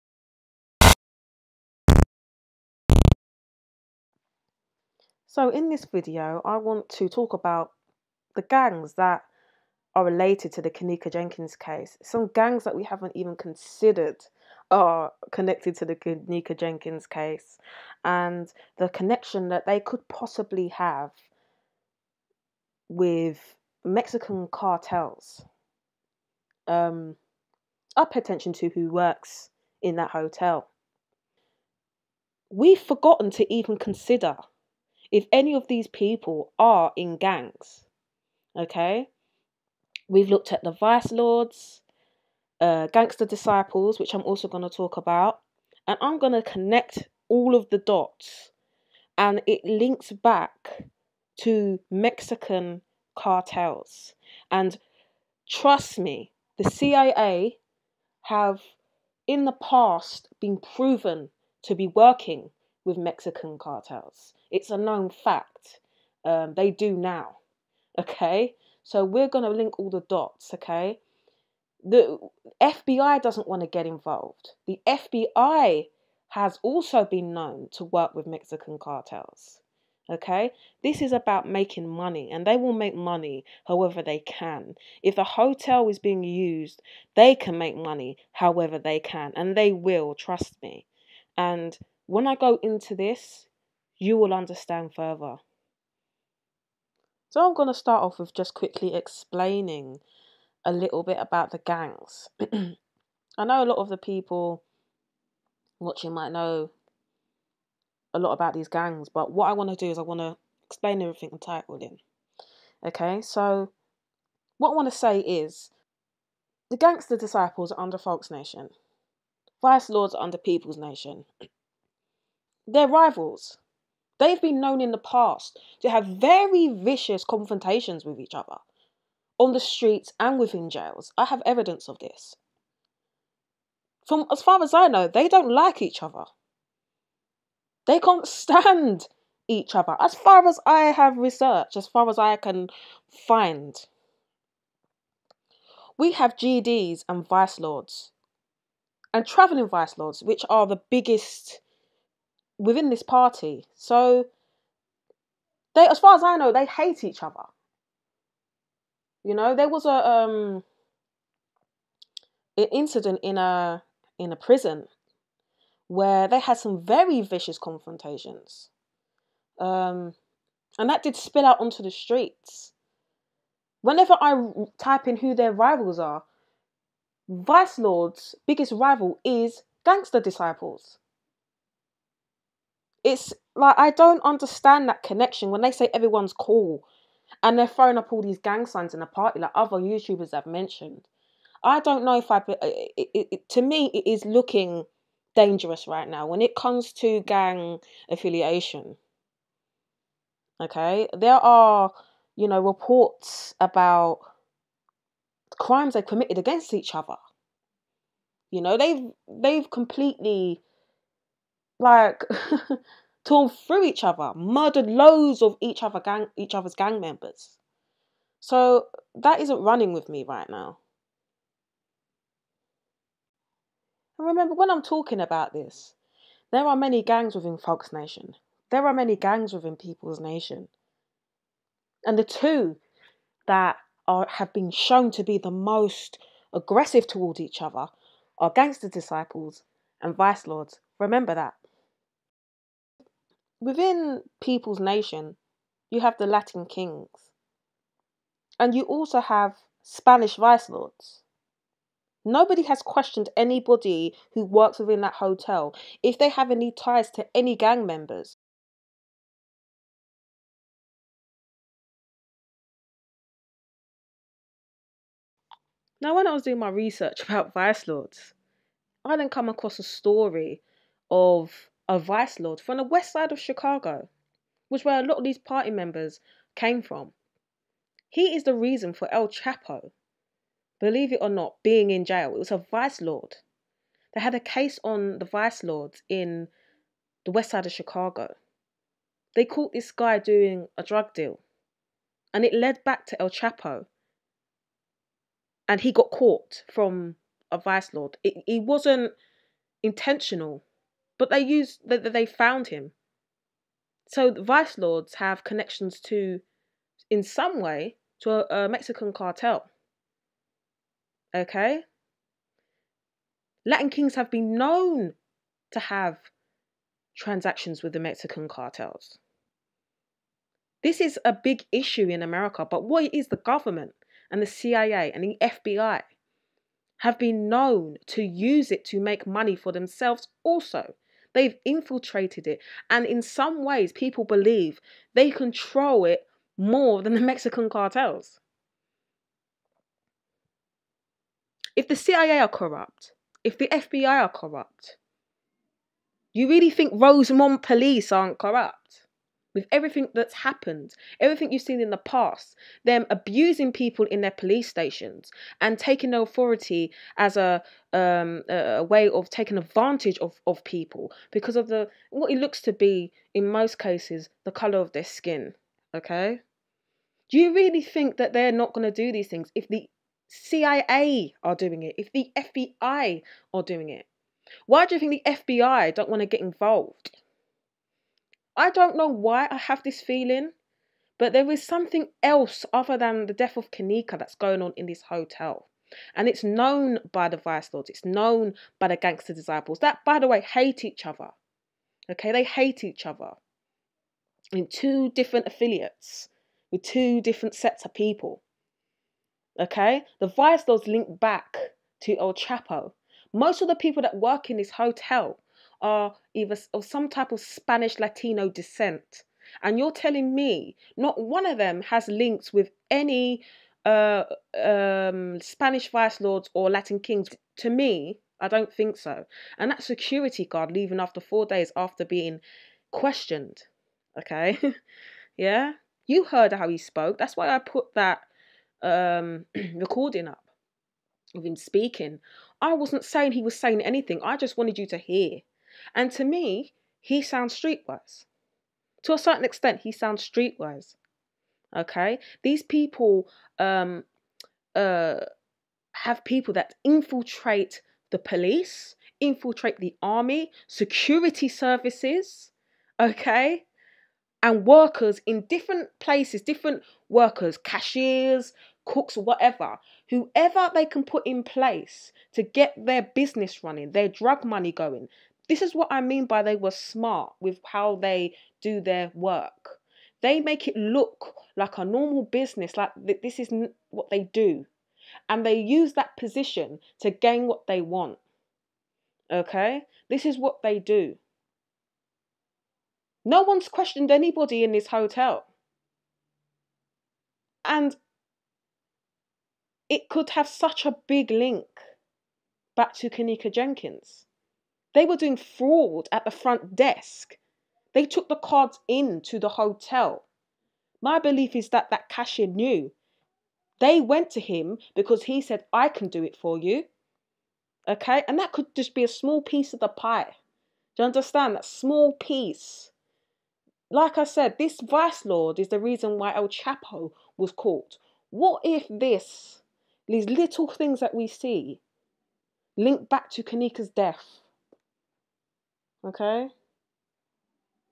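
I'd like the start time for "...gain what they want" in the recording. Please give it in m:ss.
7:57.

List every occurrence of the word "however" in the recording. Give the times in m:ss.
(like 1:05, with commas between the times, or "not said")
1:23, 1:28.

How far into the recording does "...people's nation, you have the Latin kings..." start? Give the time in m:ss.
4:04.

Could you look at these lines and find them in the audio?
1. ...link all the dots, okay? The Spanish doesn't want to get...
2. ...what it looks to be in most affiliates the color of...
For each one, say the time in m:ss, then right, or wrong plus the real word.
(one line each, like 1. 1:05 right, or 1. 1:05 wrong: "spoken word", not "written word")
1. 1:09 wrong: "FBI", not "Spanish"
2. 6:02 wrong: "cases", not "affiliates".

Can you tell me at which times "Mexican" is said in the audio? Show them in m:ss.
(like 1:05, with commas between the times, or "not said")
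0:23, 0:51, 1:02, 1:18, 5:08, 5:17, 5:37.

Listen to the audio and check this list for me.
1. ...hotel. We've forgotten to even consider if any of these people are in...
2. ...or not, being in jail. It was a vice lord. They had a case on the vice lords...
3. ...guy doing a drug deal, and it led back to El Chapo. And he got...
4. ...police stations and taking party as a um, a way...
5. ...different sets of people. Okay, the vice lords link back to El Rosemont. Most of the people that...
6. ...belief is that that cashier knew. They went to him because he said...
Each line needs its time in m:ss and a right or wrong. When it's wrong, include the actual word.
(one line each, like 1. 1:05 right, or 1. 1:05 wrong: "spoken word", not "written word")
1. 0:30 right
2. 4:41 right
3. 4:49 right
4. 5:54 wrong: "authority", not "party"
5. 6:37 wrong: "Chapo", not "Rosemont"
6. 8:21 right.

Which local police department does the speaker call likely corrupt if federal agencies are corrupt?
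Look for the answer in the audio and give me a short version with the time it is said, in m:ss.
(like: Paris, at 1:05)
Rosemont police, at 5:46.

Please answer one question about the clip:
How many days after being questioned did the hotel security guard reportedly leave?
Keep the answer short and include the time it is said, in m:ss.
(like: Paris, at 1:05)
4, at 7:01.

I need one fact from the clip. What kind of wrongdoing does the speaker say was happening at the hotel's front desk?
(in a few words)
Fraud.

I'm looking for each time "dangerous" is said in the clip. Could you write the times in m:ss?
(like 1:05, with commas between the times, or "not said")
3:15.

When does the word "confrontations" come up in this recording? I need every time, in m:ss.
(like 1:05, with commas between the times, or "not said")
2:07, 2:47.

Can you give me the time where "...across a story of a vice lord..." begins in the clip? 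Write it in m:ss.
4:29.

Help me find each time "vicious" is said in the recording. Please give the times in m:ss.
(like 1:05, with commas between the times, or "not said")
2:06, 2:47.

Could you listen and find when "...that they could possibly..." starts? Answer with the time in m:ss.
0:19.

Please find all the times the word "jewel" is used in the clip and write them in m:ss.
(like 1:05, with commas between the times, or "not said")
not said.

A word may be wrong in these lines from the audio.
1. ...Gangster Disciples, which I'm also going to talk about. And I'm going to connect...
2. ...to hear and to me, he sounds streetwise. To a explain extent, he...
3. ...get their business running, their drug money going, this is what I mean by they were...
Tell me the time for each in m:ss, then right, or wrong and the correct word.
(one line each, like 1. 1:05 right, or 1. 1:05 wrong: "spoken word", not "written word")
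1. 0:42 right
2. 7:14 wrong: "certain", not "explain"
3. 7:42 right.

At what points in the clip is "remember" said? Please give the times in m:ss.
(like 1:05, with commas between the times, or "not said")
3:44, 4:00.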